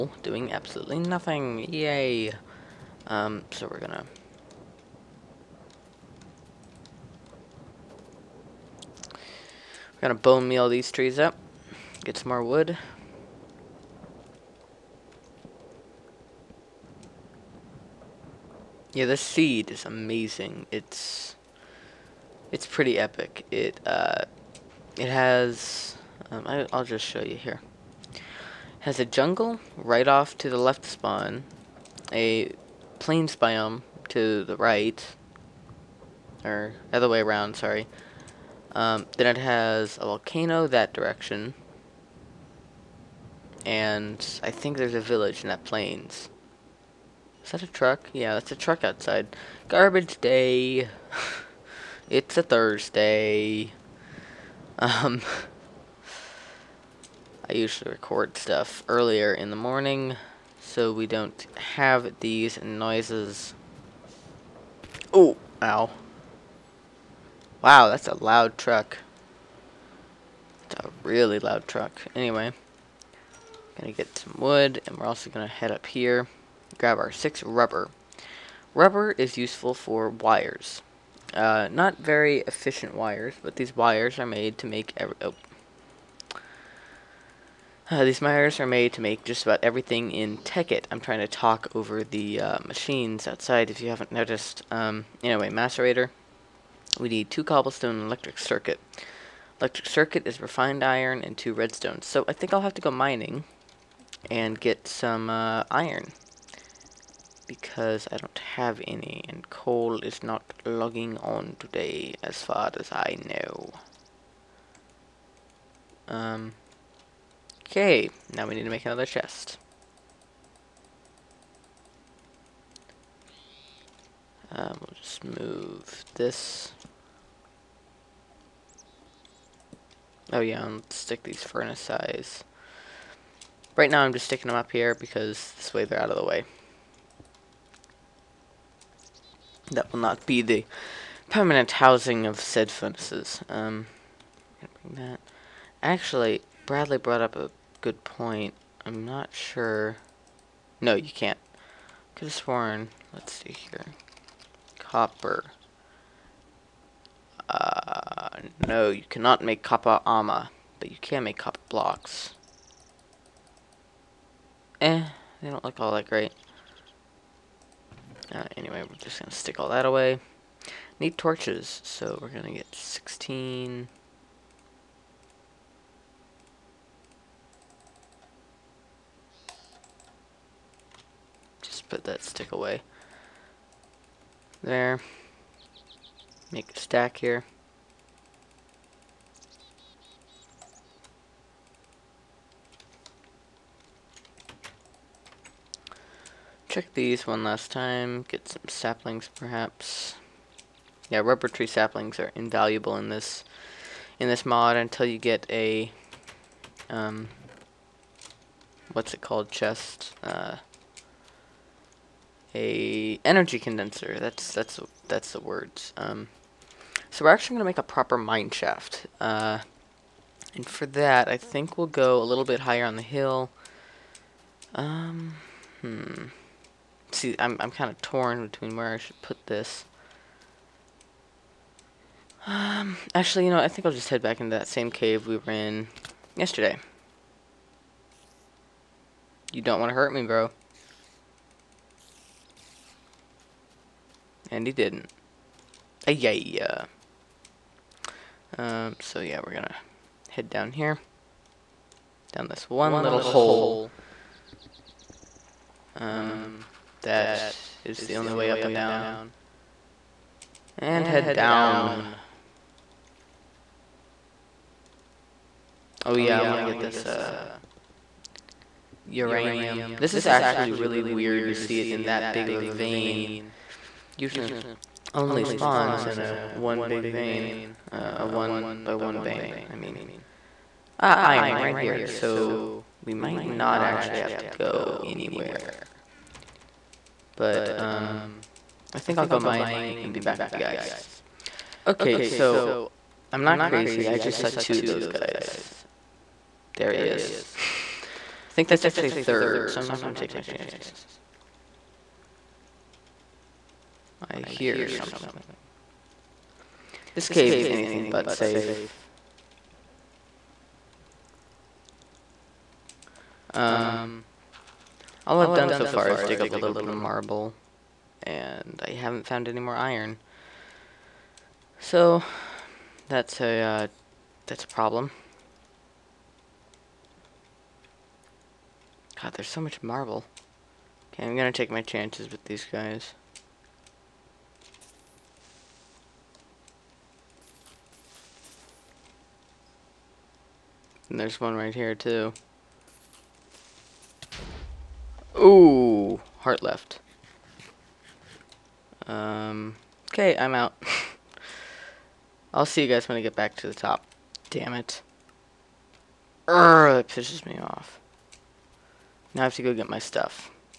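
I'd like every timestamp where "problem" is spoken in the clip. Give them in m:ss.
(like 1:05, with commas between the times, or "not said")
5:24.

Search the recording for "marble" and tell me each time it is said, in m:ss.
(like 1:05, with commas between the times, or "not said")
5:16, 5:29.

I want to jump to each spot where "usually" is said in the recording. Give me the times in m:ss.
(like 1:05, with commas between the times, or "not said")
0:57, 4:34.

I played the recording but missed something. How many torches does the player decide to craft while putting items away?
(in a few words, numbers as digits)
16.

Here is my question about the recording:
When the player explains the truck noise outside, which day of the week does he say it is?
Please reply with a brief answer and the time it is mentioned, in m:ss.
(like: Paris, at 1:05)
Thursday, at 0:52.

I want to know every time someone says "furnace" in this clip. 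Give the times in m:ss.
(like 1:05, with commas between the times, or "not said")
2:11, 2:22.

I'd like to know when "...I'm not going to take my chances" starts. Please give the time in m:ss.
4:59.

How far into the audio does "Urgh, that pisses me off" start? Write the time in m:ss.
5:56.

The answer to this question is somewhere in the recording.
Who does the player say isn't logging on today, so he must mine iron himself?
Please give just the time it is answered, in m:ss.
1:49.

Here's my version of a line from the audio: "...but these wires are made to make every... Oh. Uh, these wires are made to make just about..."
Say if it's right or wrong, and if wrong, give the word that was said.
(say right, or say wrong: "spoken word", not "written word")
right.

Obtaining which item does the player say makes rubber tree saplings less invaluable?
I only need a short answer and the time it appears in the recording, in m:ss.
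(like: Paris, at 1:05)
energy condenser, at 3:33.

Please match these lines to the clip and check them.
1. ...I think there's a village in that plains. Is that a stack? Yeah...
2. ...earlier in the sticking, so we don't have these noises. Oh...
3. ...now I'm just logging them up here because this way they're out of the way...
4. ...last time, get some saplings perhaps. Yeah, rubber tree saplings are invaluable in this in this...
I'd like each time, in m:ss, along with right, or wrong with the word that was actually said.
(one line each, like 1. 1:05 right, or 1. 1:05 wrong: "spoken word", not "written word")
1. 0:44 wrong: "truck", not "stack"
2. 0:58 wrong: "morning", not "sticking"
3. 2:13 wrong: "sticking", not "logging"
4. 3:17 right.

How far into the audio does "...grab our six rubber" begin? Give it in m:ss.
1:16.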